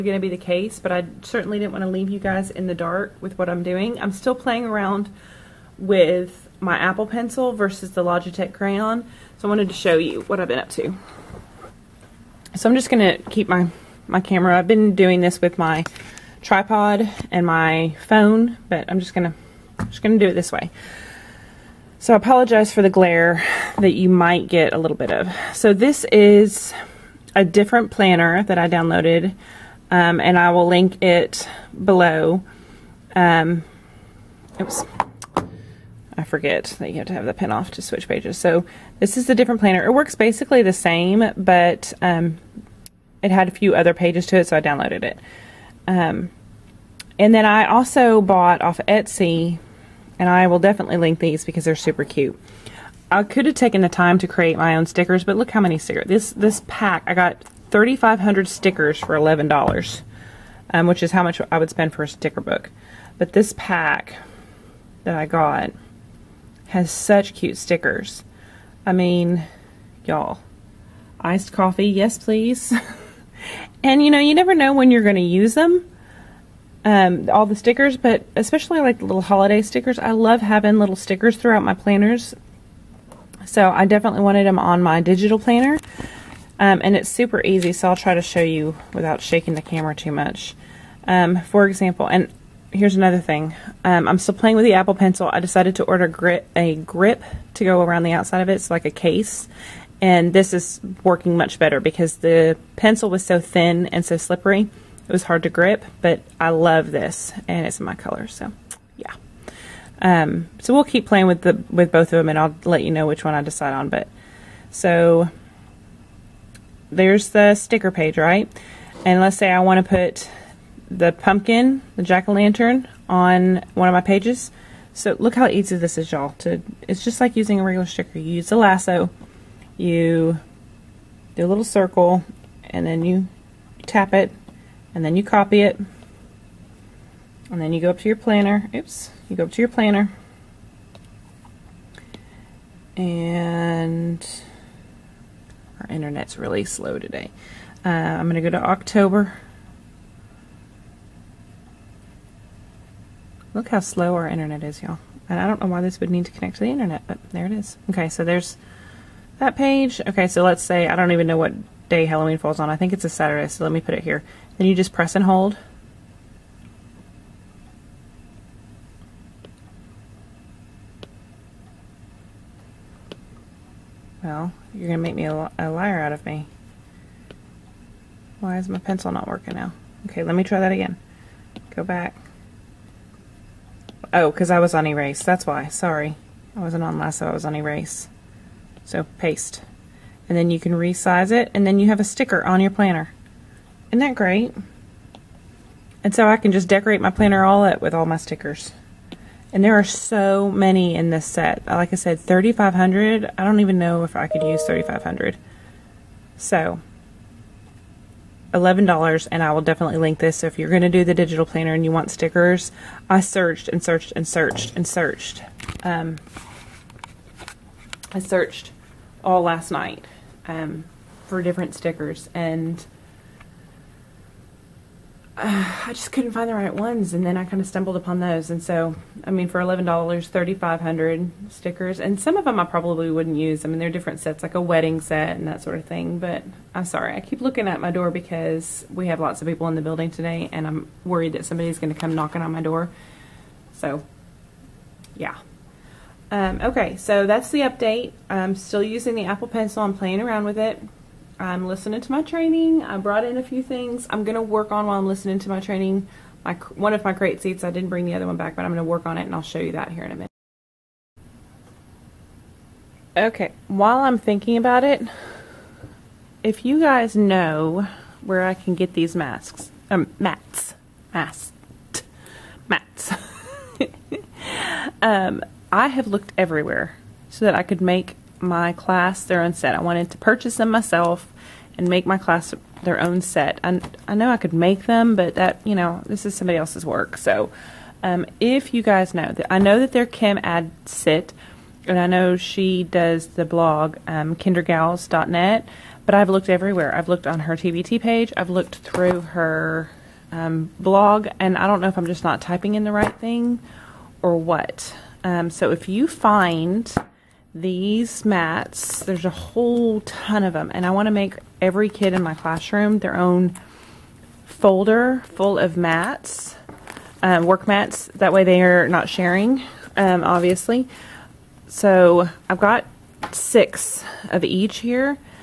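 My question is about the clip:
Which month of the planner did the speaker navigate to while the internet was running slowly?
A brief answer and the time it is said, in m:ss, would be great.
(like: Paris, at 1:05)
October, at 2:28.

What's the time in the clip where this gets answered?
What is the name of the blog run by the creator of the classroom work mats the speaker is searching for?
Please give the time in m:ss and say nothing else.
4:54.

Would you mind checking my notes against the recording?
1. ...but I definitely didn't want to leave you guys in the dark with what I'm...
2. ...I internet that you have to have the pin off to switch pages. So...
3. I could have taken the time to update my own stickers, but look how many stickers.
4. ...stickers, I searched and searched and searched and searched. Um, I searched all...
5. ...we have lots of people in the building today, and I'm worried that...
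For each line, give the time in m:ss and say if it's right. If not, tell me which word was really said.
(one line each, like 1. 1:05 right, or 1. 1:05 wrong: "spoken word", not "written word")
1. 0:00 wrong: "certainly", not "definitely"
2. 0:36 wrong: "forget", not "internet"
3. 0:53 wrong: "create", not "update"
4. 3:32 right
5. 3:58 right.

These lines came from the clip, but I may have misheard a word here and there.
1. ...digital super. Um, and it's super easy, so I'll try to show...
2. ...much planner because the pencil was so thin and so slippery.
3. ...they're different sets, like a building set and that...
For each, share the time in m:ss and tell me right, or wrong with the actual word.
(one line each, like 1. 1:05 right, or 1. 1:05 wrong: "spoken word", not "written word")
1. 1:25 wrong: "planner", not "super"
2. 1:41 wrong: "better", not "planner"
3. 3:53 wrong: "wedding", not "building".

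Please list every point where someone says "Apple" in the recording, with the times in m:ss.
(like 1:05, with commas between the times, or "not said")
0:06, 1:34, 4:09.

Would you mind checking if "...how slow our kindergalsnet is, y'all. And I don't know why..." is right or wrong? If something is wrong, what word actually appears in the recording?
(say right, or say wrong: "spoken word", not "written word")
wrong: "internet", not "kindergalsnet".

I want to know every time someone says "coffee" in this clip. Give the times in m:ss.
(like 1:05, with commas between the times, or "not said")
1:11.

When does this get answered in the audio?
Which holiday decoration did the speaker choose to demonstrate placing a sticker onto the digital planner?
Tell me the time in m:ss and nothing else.
2:02.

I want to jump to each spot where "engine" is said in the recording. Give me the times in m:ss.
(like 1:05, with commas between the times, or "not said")
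not said.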